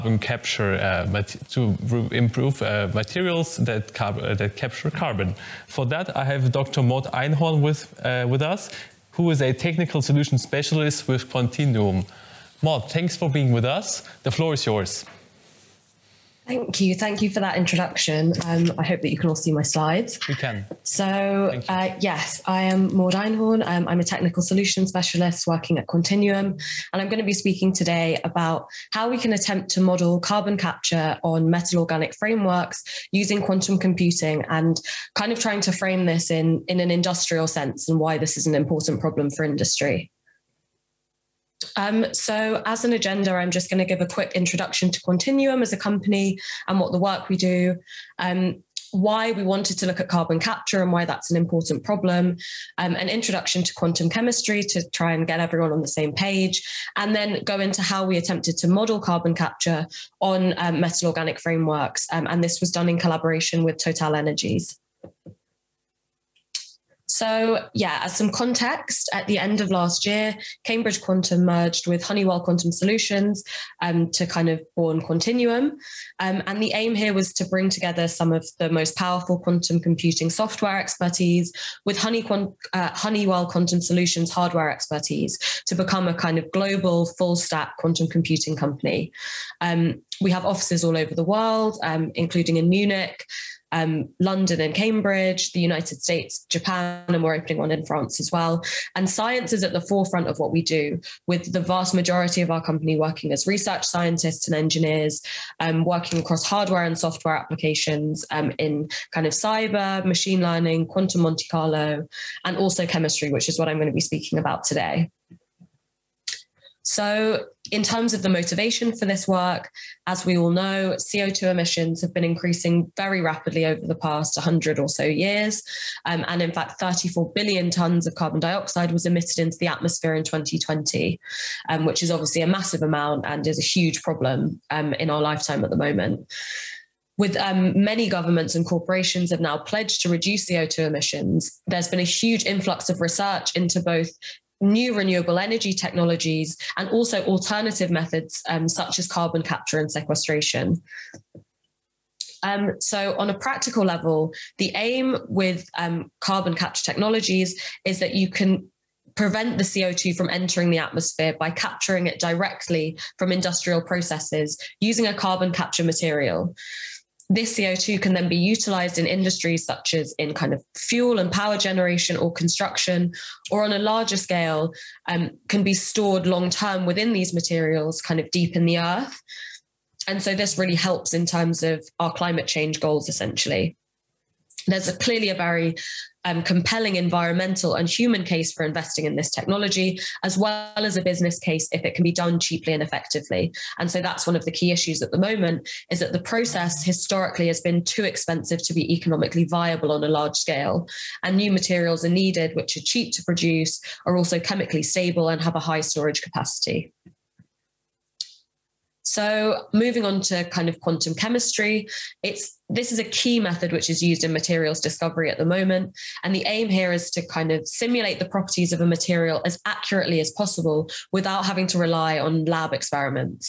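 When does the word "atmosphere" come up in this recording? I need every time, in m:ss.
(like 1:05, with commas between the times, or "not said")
2:09, 2:40.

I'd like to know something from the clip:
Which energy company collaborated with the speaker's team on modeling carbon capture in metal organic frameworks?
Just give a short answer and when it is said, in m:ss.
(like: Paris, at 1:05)
Total Energies, at 1:03.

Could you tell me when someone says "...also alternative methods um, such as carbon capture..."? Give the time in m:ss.
2:26.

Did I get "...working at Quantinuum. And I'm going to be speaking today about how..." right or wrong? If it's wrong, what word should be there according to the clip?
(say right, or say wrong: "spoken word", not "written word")
right.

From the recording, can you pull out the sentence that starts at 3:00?
And so this really helps in terms of our climate change goals, essentially.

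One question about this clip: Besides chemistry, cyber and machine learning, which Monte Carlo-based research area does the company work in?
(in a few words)
quantum Monte Carlo.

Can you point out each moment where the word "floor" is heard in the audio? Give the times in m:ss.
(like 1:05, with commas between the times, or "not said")
0:14.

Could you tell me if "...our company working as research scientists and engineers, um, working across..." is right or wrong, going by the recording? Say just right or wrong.
right.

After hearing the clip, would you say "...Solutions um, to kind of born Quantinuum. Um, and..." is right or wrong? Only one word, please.
right.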